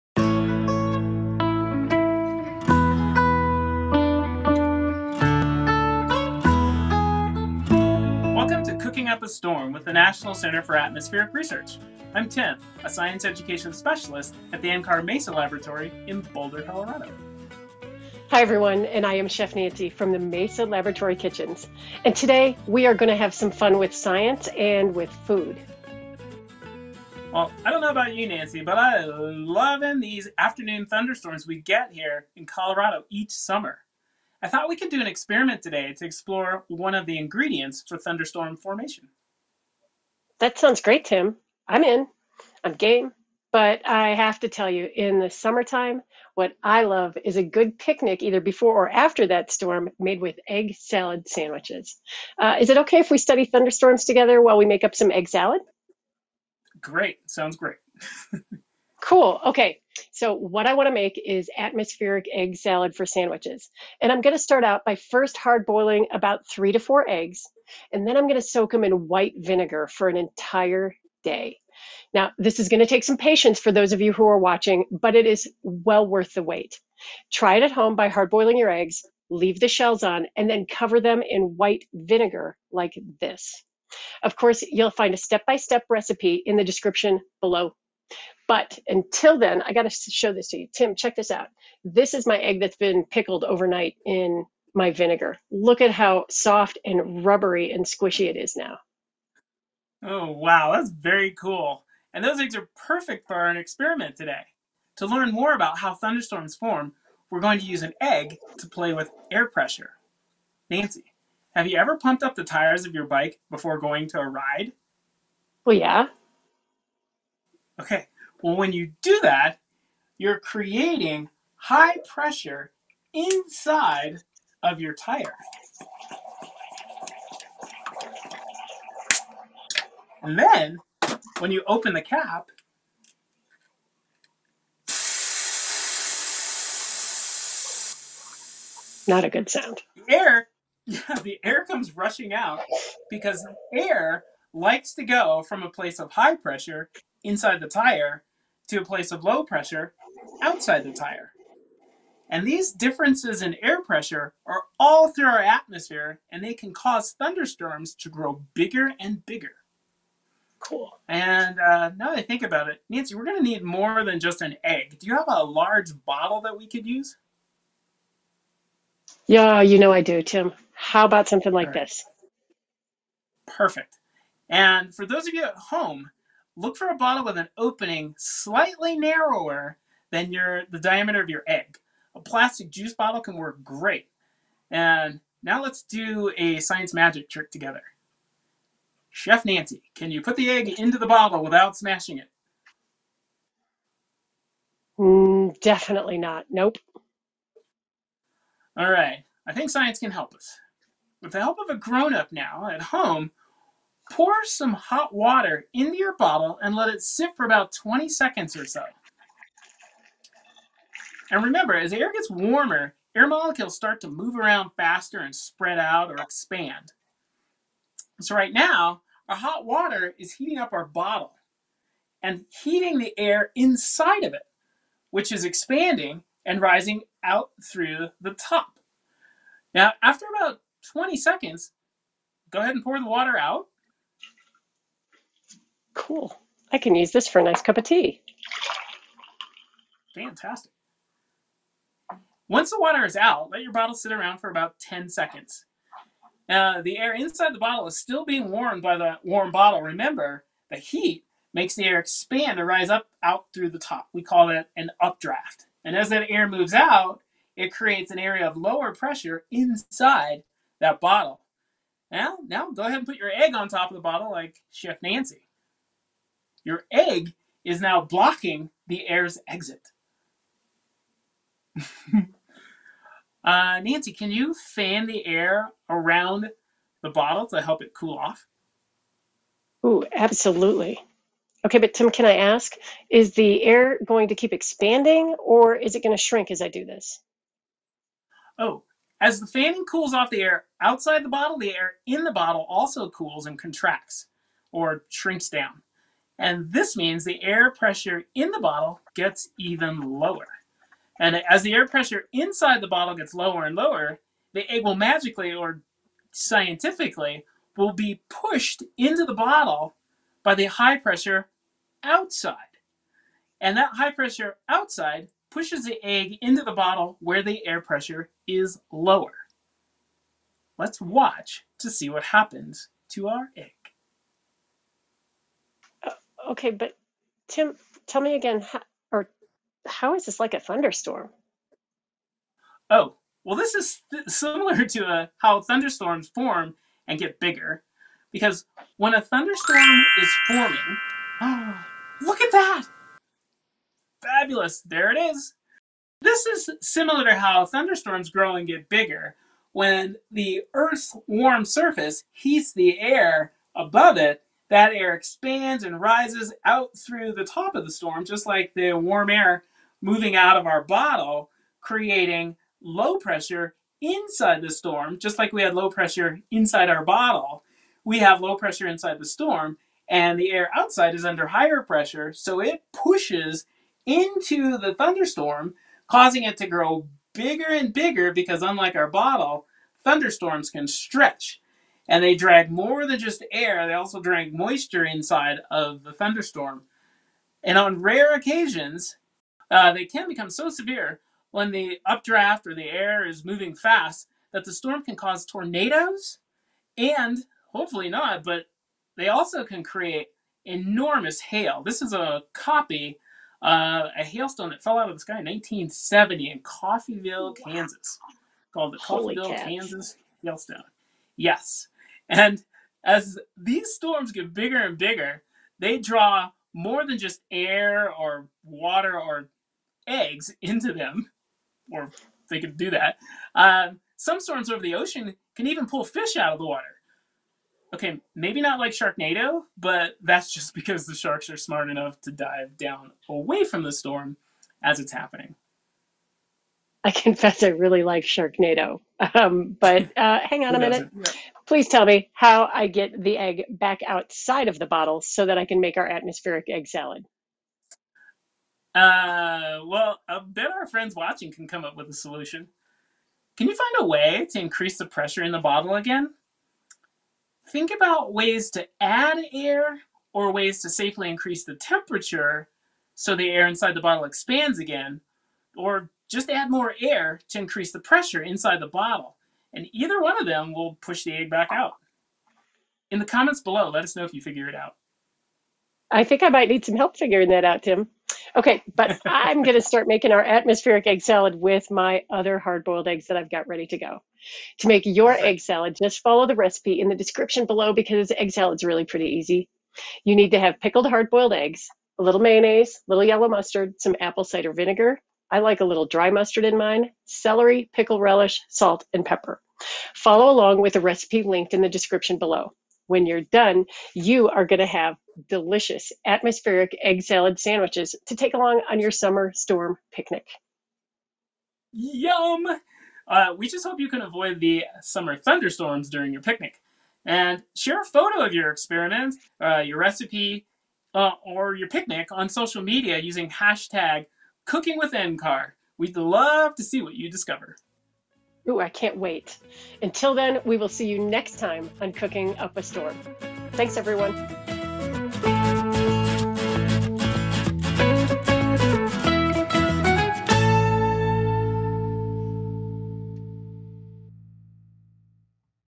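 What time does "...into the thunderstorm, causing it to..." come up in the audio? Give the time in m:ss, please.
6:14.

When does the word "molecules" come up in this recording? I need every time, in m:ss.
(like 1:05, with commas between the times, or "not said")
3:33.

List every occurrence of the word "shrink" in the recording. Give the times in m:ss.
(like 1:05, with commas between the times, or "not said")
4:46, 4:55.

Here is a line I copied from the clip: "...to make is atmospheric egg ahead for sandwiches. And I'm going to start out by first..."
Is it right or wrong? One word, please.
wrong.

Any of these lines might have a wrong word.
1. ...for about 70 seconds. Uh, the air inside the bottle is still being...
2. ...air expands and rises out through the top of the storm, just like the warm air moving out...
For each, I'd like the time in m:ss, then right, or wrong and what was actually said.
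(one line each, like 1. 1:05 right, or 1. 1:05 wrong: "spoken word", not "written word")
1. 4:04 wrong: "10", not "70"
2. 5:54 right.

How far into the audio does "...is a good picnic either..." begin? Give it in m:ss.
0:47.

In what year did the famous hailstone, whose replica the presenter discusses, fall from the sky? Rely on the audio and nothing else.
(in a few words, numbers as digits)
1970.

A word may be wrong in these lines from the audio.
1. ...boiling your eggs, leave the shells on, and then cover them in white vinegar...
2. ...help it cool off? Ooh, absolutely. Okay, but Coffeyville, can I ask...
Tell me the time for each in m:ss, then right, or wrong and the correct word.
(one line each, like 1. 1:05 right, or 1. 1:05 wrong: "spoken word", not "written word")
1. 1:18 right
2. 4:37 wrong: "Tim", not "Coffeyville".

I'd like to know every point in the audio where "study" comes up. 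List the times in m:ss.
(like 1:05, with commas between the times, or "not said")
0:53.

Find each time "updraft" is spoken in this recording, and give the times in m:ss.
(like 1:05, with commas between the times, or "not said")
4:14, 6:32.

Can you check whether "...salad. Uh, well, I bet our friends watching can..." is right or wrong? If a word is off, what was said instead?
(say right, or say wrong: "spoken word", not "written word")
right.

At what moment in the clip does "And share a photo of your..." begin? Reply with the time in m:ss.
8:37.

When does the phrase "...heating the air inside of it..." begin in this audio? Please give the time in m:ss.
3:42.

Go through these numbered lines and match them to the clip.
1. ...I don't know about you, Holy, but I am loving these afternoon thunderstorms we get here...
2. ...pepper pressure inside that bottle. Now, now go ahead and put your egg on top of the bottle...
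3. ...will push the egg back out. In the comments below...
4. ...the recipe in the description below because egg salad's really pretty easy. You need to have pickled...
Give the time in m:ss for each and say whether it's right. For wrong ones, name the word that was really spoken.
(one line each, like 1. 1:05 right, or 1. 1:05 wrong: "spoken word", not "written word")
1. 0:27 wrong: "Nancy", not "Holy"
2. 4:18 wrong: "lower", not "pepper"
3. 7:50 right
4. 8:06 right.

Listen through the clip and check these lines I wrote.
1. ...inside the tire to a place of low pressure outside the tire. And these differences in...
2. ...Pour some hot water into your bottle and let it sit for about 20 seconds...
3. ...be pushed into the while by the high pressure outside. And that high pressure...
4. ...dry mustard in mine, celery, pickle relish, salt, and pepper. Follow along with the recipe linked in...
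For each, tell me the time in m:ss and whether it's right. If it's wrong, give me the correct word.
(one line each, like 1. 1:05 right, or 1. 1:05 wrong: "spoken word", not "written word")
1. 2:27 right
2. 3:24 right
3. 5:07 wrong: "bottle", not "while"
4. 8:16 right.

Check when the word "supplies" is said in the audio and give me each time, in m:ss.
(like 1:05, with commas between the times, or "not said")
not said.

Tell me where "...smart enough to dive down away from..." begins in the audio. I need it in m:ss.
7:11.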